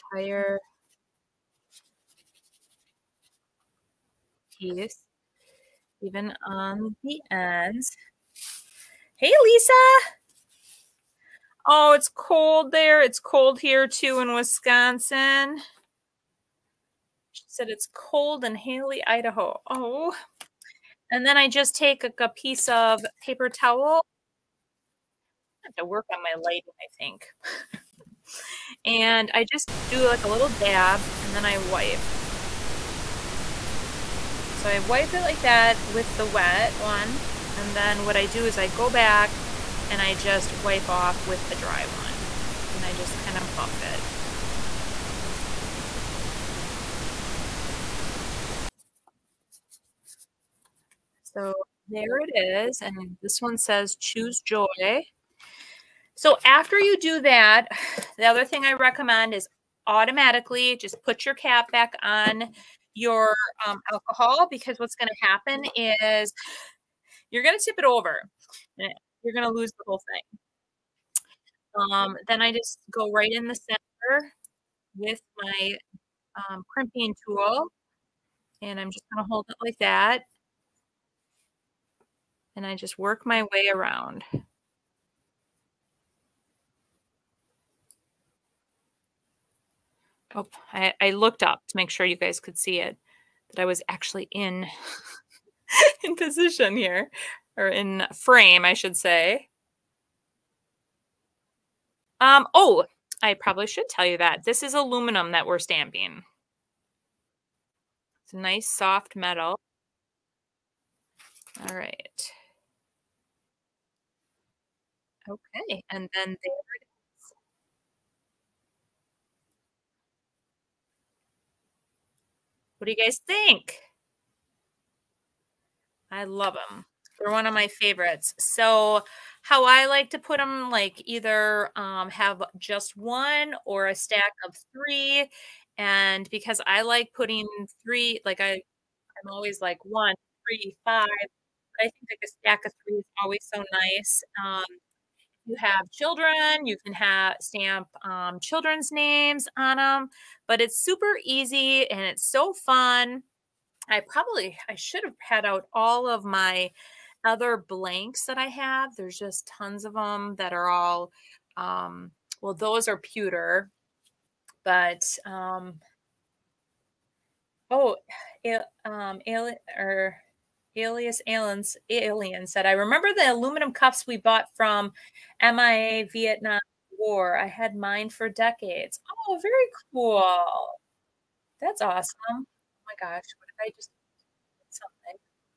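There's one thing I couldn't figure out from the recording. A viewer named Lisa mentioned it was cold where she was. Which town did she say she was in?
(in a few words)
Hailey, Idaho.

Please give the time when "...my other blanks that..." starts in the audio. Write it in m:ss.
2:36.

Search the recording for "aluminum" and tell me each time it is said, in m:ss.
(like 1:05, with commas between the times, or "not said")
1:44, 2:53.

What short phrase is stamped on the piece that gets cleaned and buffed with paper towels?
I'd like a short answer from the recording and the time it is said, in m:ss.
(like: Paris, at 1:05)
Choose joy, at 0:53.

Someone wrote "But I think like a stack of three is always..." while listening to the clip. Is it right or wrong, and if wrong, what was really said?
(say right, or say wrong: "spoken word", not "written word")
right.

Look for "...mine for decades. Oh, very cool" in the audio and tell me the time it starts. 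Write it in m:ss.
2:57.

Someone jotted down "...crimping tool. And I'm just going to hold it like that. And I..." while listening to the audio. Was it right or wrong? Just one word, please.
right.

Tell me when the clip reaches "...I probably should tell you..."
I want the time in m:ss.
1:43.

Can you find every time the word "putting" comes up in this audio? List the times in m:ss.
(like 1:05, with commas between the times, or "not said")
2:17.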